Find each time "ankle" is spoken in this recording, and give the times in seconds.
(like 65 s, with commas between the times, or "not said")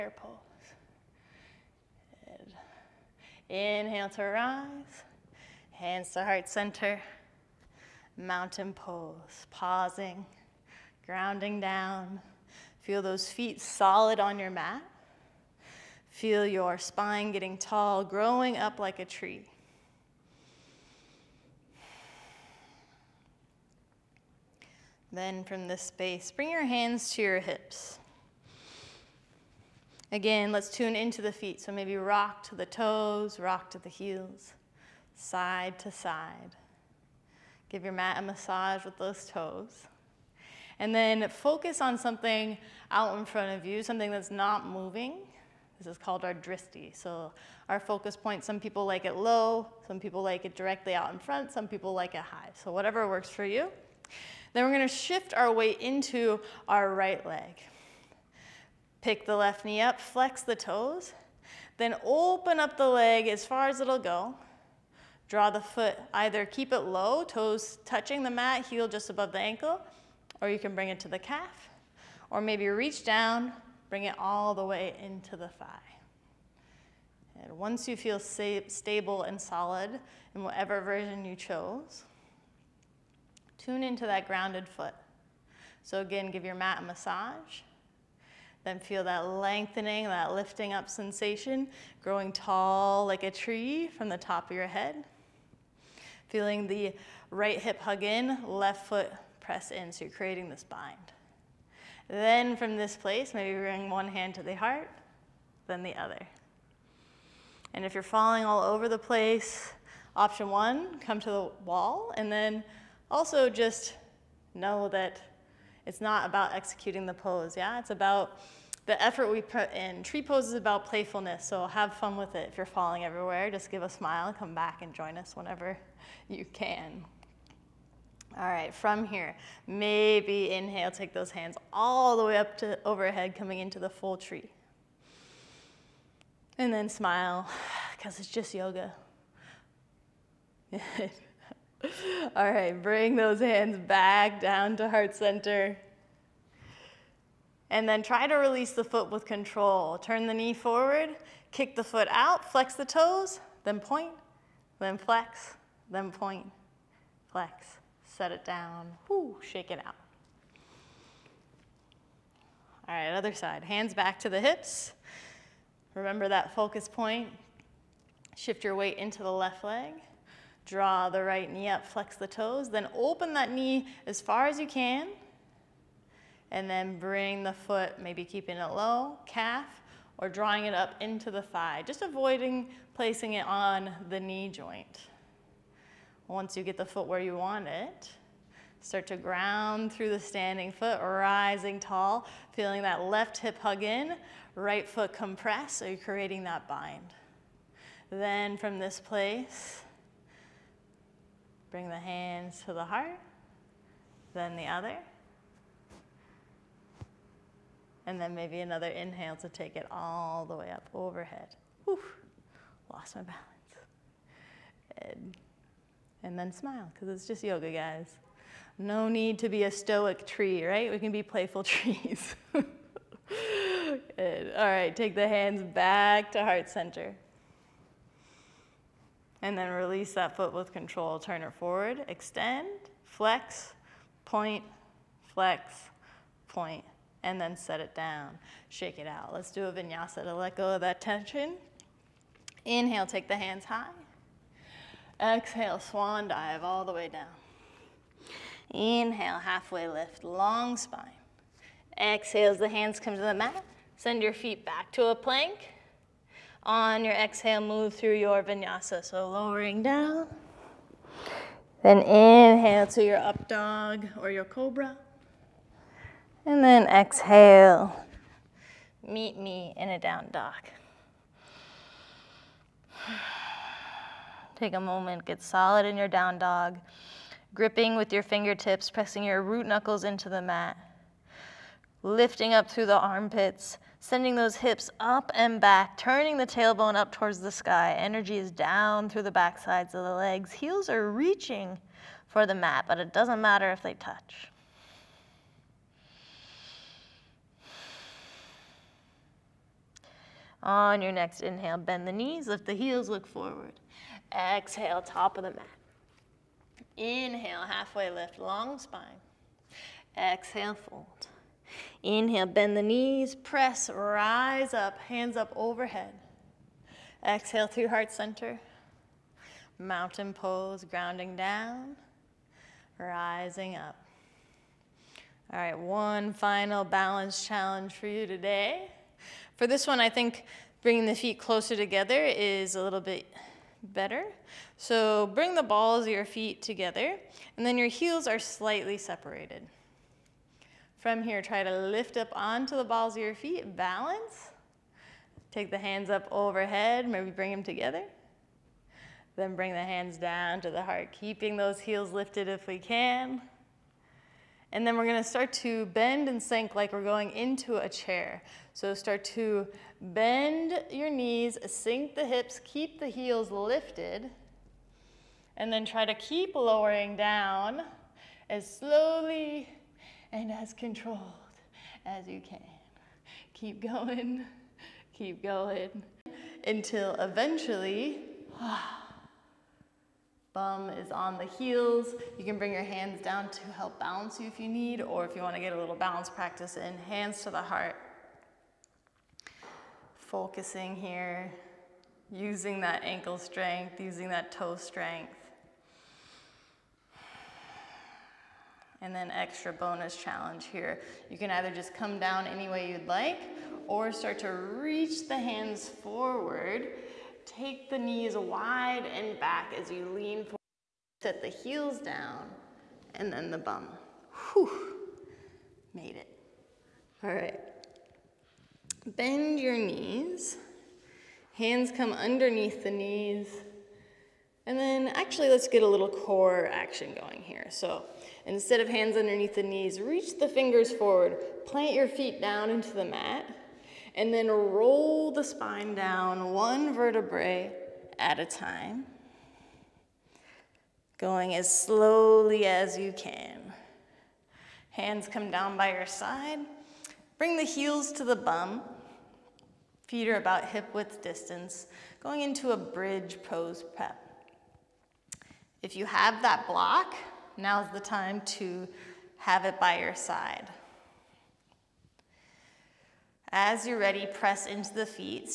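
69 s, 393 s.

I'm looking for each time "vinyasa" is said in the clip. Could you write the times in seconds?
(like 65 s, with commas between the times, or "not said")
239 s, 258 s.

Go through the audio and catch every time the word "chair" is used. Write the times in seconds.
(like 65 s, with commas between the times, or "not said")
357 s.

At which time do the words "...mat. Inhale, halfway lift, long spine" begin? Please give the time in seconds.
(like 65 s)
305 s.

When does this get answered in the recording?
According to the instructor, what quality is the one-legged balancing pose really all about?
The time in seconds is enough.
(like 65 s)
120 s.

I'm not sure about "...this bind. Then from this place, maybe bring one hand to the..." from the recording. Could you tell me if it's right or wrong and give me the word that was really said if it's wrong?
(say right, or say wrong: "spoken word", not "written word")
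right.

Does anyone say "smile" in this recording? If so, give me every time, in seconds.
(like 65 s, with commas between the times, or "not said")
123 s, 136 s, 216 s.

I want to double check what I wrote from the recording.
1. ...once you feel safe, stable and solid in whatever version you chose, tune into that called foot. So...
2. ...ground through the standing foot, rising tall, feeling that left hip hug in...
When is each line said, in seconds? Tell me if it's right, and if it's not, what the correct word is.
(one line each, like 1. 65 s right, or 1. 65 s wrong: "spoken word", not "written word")
1. 77 s wrong: "grounded", not "called"
2. 189 s right.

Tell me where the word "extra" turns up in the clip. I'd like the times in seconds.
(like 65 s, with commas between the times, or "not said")
399 s.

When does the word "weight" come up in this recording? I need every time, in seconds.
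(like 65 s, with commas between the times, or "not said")
55 s, 168 s.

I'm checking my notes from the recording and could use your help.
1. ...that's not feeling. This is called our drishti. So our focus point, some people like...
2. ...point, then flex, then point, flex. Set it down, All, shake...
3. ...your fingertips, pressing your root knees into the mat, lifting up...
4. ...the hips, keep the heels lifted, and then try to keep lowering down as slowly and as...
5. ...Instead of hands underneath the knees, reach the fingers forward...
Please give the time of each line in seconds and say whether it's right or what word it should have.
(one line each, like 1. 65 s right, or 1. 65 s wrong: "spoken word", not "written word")
1. 44 s wrong: "moving", not "feeling"
2. 153 s wrong: "Woo", not "All"
3. 278 s wrong: "knuckles", not "knees"
4. 362 s right
5. 428 s right.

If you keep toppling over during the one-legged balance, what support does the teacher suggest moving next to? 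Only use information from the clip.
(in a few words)
the wall.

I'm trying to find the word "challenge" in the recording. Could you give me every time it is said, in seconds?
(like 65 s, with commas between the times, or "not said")
327 s, 400 s.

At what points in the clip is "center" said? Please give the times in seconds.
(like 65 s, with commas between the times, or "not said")
6 s, 145 s, 226 s, 318 s.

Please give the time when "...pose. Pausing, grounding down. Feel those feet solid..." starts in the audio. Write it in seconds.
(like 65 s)
8 s.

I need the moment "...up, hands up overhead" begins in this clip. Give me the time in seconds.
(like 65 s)
314 s.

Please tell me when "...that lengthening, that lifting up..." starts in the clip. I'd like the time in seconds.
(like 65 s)
89 s.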